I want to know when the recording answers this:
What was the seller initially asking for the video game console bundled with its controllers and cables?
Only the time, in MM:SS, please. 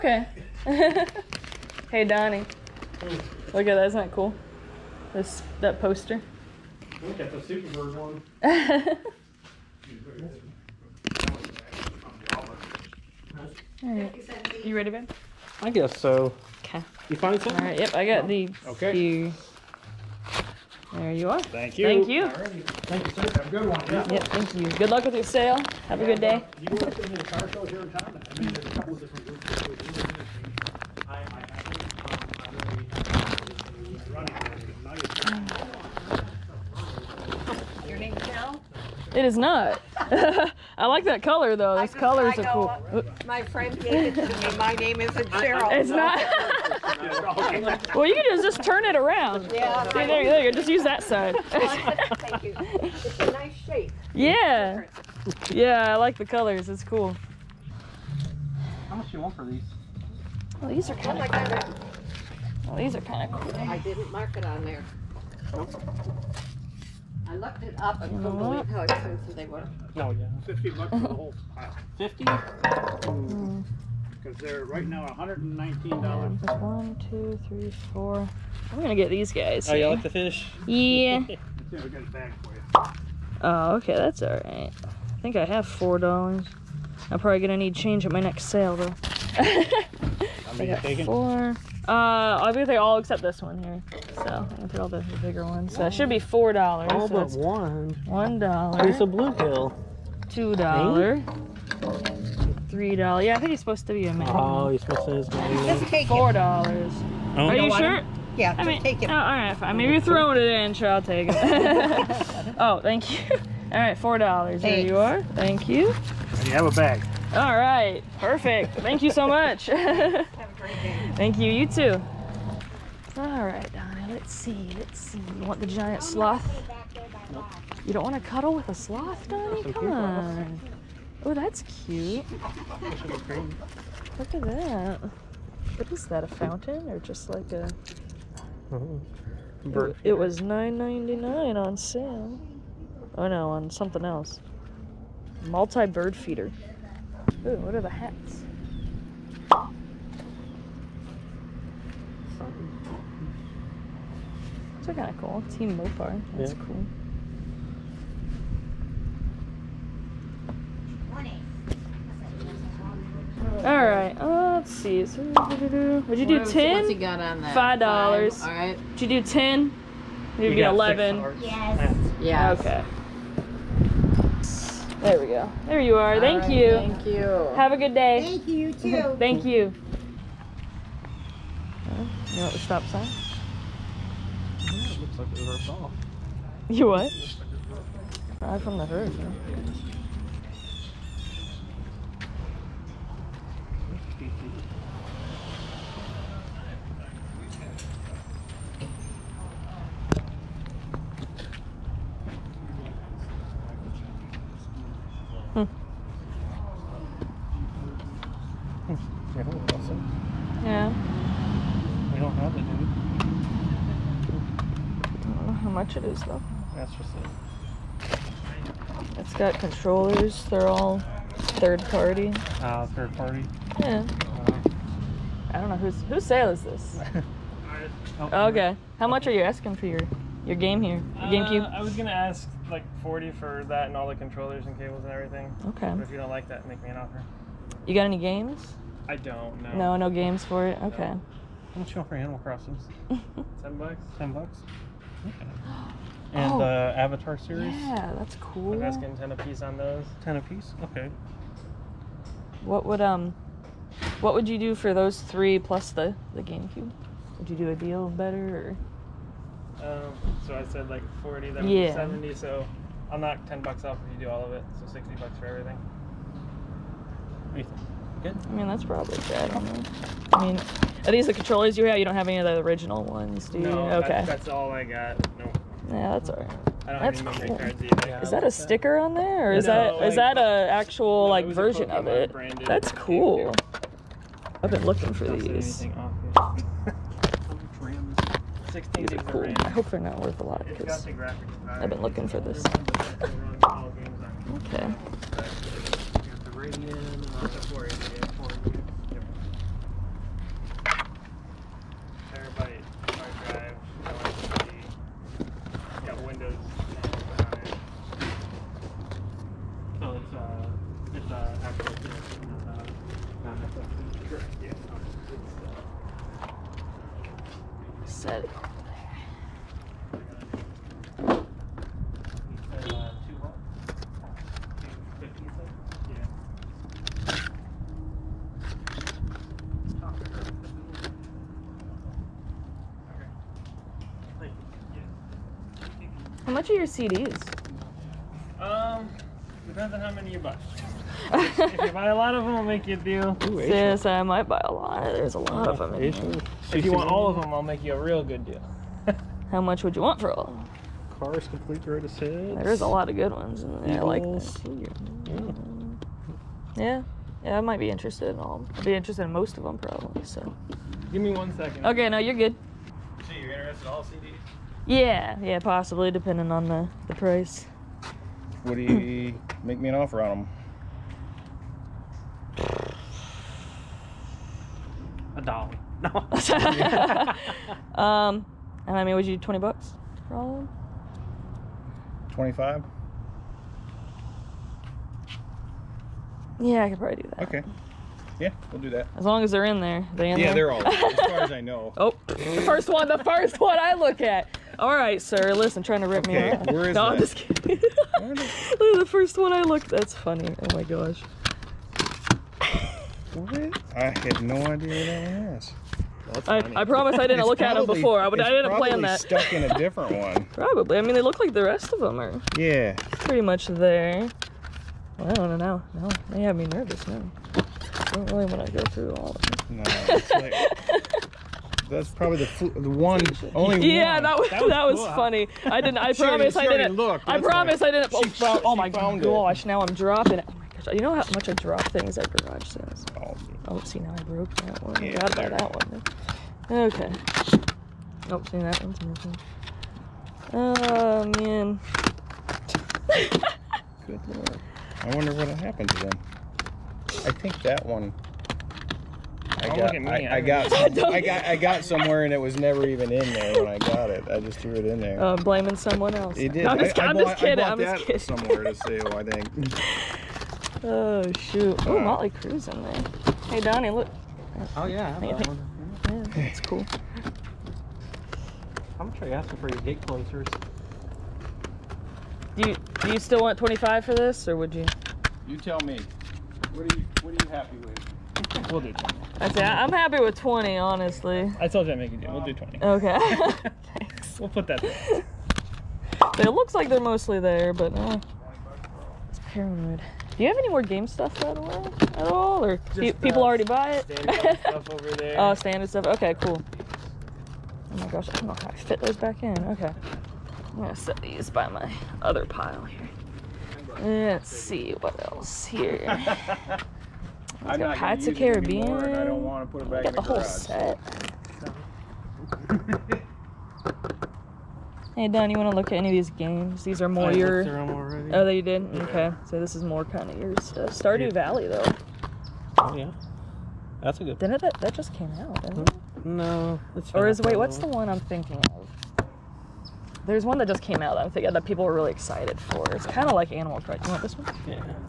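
03:53.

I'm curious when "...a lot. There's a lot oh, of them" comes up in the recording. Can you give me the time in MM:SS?
05:44.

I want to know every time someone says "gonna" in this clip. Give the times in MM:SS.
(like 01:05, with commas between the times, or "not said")
01:18, 01:27, 01:34, 03:51, 07:49, 08:20.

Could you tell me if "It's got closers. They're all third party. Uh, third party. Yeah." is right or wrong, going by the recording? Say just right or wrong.
wrong.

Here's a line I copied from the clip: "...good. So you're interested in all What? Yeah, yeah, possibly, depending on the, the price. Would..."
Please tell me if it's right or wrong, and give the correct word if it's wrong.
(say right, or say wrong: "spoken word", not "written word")
wrong: "CDs", not "What".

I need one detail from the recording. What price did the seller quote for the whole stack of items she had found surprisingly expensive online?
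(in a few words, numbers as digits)
$50.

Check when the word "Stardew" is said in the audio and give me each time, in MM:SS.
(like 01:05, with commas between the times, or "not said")
08:40.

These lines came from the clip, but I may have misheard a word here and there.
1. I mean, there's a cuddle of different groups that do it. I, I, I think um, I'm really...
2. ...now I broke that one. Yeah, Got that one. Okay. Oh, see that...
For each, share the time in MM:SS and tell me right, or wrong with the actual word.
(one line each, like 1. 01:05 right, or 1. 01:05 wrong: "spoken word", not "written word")
1. 00:28 wrong: "couple", not "cuddle"
2. 07:13 right.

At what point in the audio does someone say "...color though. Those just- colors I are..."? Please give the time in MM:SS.
00:41.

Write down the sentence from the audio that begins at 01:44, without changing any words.
Oh, you're supposed to be a man.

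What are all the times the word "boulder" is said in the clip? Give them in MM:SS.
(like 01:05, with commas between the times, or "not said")
not said.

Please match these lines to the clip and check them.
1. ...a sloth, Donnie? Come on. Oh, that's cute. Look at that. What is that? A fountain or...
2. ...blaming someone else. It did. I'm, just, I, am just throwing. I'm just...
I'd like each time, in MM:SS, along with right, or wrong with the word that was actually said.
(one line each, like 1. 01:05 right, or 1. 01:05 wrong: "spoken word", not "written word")
1. 02:08 right
2. 07:35 wrong: "kidding", not "throwing".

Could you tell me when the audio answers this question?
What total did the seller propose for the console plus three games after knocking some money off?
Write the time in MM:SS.
04:24.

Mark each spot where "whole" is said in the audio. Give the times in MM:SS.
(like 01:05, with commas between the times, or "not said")
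01:11, 08:30.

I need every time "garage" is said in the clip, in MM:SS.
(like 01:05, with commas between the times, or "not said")
07:12, 08:30.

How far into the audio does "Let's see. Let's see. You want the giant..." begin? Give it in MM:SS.
02:04.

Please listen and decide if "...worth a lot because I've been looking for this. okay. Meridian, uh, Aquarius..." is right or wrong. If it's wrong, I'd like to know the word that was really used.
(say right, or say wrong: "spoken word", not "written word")
right.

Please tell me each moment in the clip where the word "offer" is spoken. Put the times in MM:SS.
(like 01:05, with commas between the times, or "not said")
03:56, 06:09.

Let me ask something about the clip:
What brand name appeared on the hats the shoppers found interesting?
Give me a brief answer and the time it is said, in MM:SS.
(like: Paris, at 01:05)
Mopar, at 02:35.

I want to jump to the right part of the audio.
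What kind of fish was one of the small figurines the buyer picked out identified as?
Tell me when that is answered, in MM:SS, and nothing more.
01:39.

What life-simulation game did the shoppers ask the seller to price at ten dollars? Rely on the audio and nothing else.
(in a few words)
Animal Crossing.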